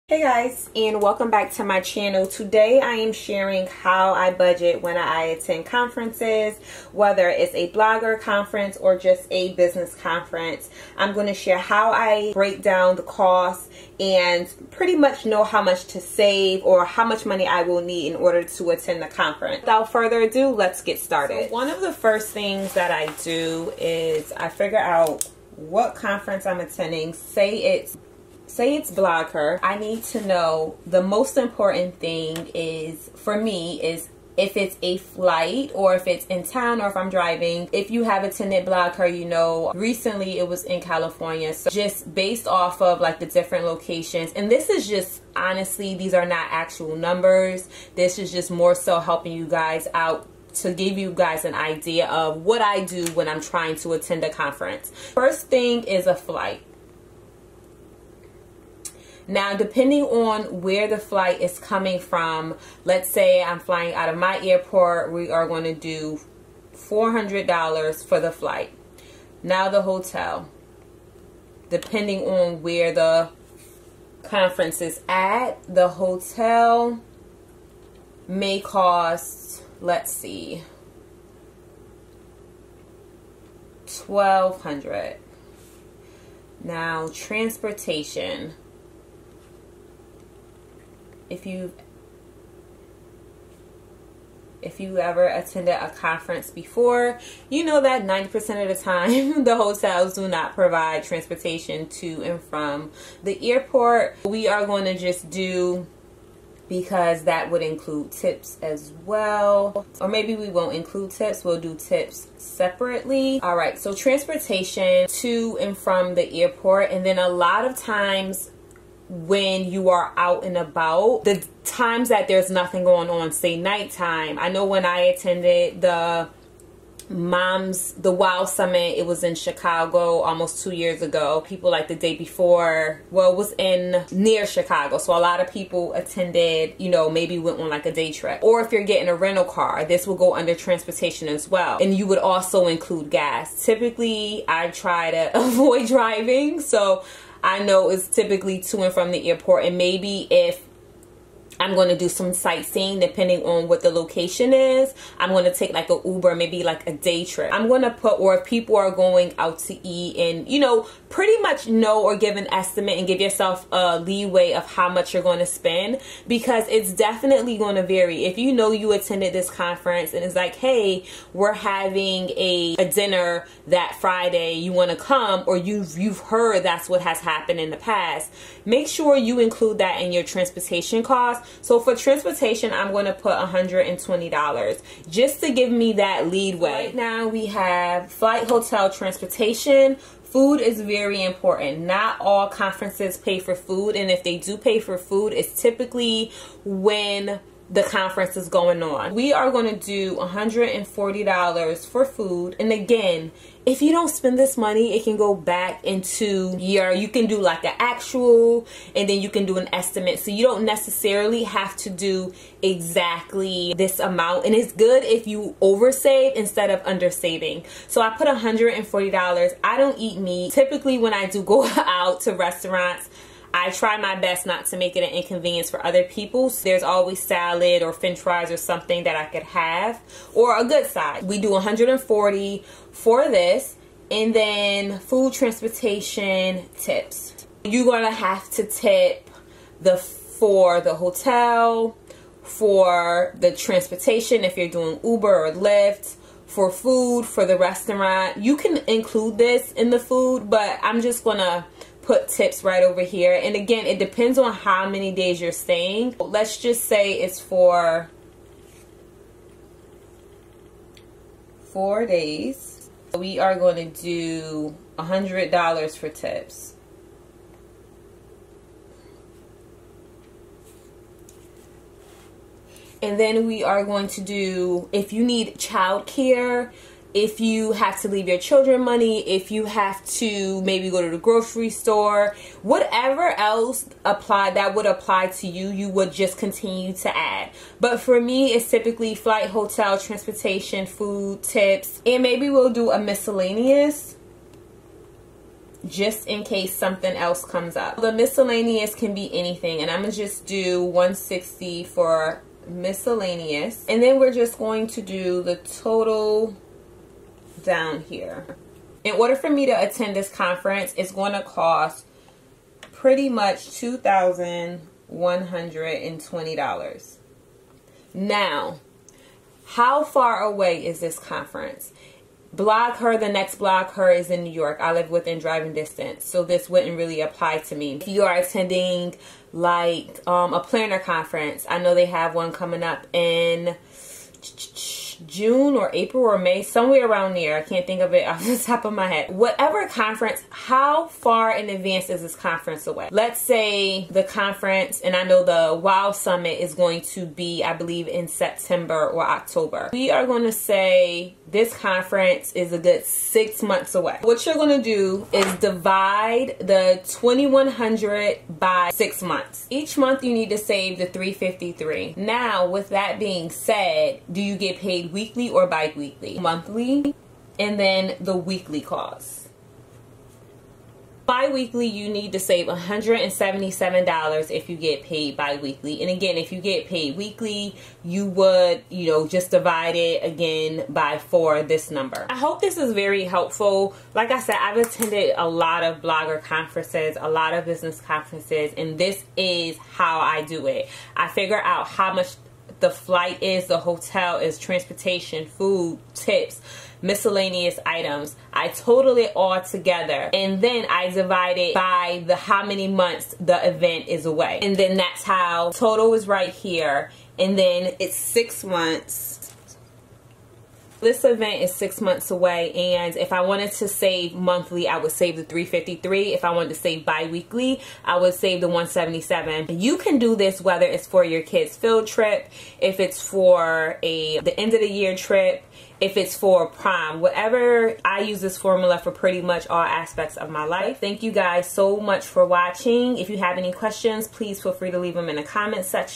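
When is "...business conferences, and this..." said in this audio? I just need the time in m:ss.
6:27.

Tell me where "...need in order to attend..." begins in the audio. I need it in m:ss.
0:17.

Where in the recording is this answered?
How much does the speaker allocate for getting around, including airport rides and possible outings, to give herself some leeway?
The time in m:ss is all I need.
3:03.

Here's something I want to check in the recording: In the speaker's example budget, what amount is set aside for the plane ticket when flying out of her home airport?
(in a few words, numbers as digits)
$400.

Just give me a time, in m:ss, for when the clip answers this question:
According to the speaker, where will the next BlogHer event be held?
5:24.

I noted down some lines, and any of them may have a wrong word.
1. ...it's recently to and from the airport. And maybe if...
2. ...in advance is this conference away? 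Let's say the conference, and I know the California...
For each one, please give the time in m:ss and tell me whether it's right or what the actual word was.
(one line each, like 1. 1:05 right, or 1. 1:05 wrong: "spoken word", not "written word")
1. 2:27 wrong: "typically", not "recently"
2. 5:41 wrong: "WOW", not "California".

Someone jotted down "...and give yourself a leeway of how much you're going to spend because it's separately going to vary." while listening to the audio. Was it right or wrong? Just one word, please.
wrong.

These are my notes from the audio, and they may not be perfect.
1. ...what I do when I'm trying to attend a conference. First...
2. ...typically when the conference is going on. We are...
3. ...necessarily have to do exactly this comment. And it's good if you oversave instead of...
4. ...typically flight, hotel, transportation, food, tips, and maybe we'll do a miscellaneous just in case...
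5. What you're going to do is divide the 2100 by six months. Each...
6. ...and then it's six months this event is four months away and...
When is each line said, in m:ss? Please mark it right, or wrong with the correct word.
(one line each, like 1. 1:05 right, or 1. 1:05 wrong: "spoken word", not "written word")
1. 0:52 right
2. 3:15 right
3. 3:30 wrong: "amount", not "comment"
4. 4:48 right
5. 5:54 right
6. 6:47 wrong: "six", not "four".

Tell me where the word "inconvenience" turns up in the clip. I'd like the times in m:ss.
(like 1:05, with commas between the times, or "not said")
3:45.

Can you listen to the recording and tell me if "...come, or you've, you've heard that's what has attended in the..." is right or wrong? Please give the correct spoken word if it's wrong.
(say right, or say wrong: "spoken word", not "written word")
wrong: "happened", not "attended".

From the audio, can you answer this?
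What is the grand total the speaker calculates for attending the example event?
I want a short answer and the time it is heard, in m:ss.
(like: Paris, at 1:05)
$2,120, at 5:13.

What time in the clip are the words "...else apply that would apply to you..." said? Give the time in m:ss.
4:43.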